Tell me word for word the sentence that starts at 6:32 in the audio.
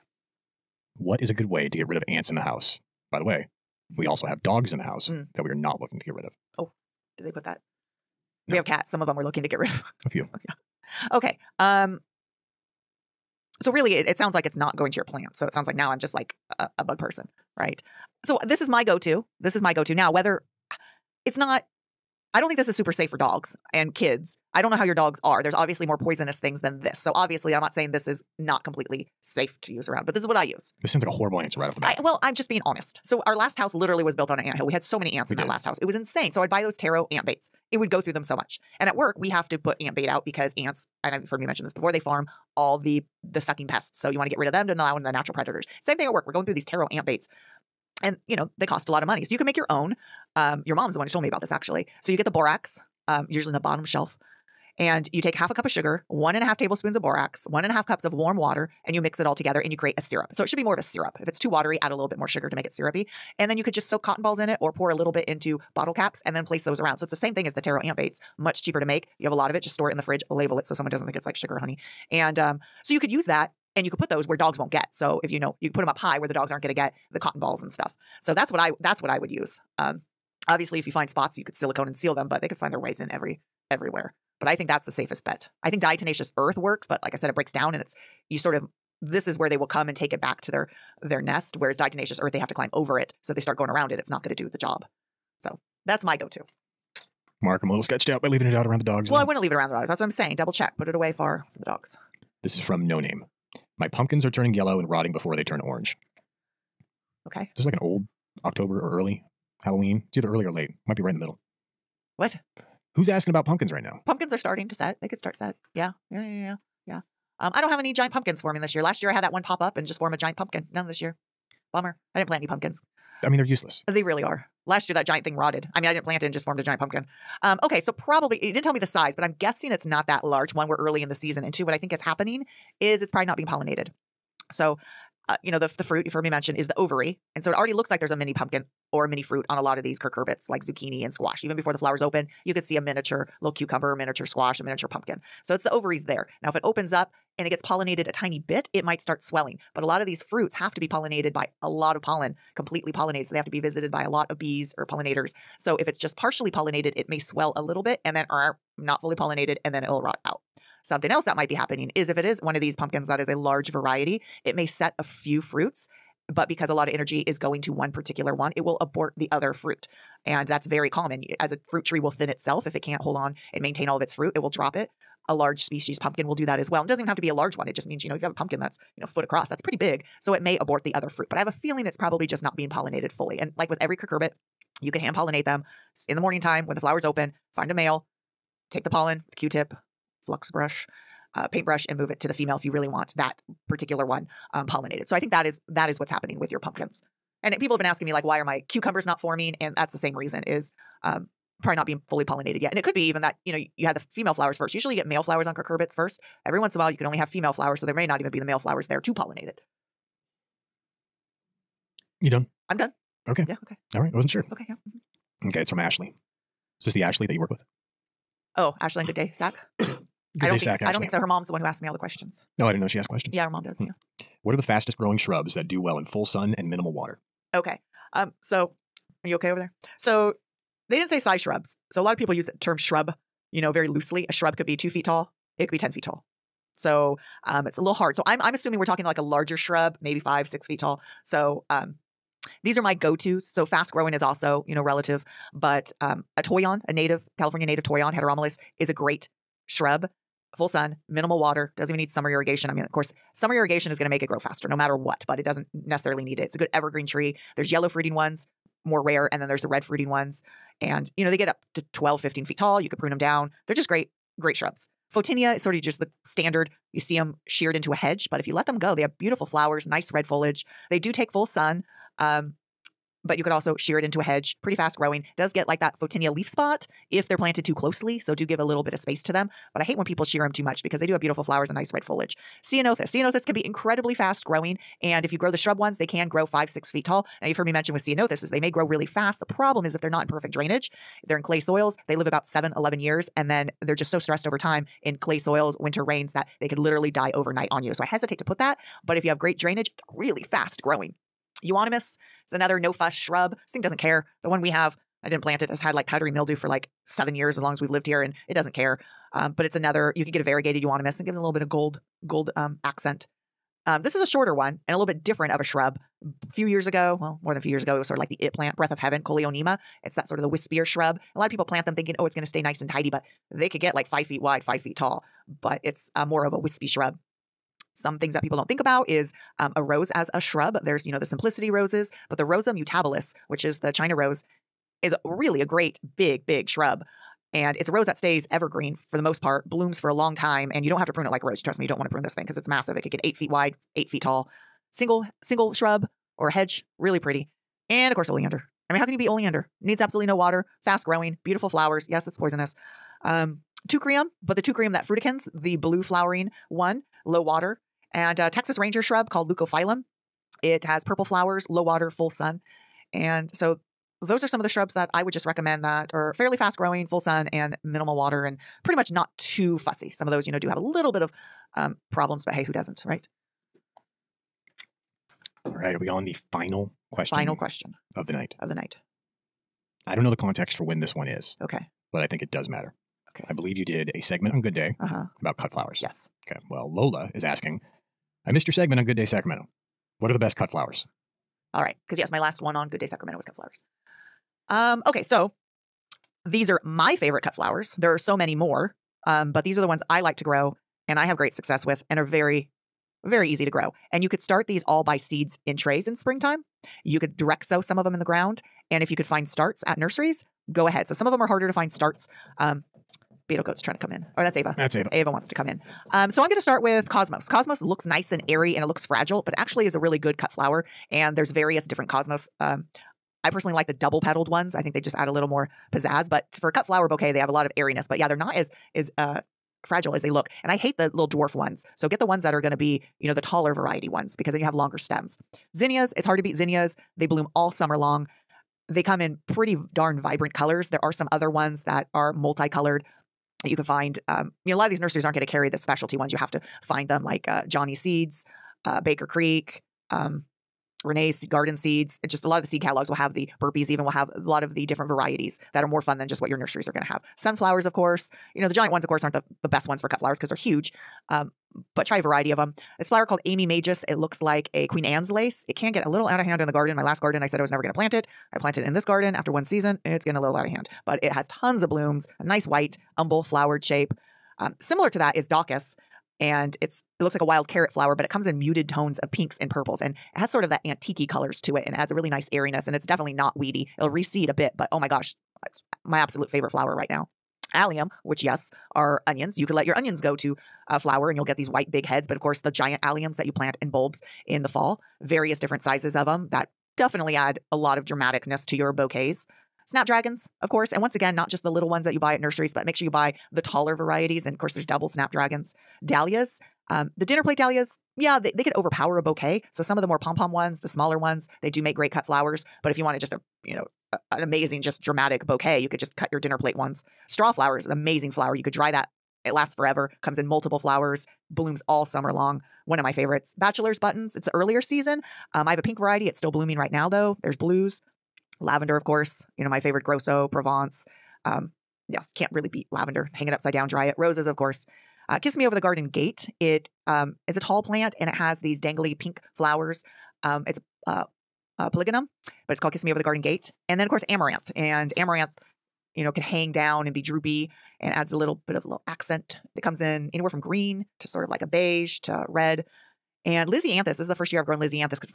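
Because, yes, my last one on Good Day Sacramento was cut flowers.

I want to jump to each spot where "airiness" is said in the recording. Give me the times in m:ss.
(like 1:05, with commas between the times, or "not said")
7:07, 8:02.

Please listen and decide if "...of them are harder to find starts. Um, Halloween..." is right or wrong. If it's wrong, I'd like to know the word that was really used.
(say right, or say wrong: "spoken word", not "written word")
wrong: "Beetle", not "Halloween".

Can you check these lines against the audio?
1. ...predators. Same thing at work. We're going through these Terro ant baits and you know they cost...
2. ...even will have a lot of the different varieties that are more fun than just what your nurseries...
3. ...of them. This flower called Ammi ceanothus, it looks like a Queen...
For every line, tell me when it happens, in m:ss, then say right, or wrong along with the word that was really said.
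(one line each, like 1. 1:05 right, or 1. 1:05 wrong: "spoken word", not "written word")
1. 0:45 right
2. 7:33 right
3. 7:42 wrong: "majus", not "ceanothus".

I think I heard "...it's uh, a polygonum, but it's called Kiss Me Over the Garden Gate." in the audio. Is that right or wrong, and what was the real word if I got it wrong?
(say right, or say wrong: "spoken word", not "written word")
right.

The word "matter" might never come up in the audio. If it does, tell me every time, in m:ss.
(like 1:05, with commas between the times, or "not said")
4:14, 6:22.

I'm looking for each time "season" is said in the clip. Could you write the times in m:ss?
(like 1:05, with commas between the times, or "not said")
2:11, 7:49, 8:44.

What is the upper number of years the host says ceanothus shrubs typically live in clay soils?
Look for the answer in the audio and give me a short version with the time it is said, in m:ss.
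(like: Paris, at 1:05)
11, at 4:52.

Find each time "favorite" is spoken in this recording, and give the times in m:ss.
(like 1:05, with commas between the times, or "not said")
6:37, 8:06, 8:43, 8:49.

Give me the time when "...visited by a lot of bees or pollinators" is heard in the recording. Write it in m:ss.
2:33.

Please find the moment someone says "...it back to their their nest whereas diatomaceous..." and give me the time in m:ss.
1:30.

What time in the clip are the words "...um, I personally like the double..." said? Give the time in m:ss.
7:02.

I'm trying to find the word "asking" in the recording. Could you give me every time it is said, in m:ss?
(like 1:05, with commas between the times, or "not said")
1:53, 3:17, 6:27.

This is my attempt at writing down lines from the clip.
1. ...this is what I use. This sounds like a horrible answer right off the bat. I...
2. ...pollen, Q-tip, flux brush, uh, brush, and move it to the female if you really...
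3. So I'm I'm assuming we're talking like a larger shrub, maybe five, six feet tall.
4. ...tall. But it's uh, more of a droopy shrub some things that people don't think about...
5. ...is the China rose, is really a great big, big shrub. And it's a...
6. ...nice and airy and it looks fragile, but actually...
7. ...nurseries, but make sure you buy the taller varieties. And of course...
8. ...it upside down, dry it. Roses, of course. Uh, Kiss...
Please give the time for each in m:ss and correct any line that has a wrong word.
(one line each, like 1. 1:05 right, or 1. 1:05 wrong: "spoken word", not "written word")
1. 0:30 right
2. 3:08 wrong: "paintbrush", not "brush"
3. 3:58 right
4. 5:24 wrong: "wispy", not "droopy"
5. 5:33 right
6. 6:58 right
7. 8:22 right
8. 8:53 right.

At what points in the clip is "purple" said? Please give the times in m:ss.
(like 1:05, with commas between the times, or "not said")
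6:01, 7:59.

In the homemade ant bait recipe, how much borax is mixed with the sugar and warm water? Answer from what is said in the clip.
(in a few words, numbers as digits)
1.5 tablespoons.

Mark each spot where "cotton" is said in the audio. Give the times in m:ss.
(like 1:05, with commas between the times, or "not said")
1:04, 1:17.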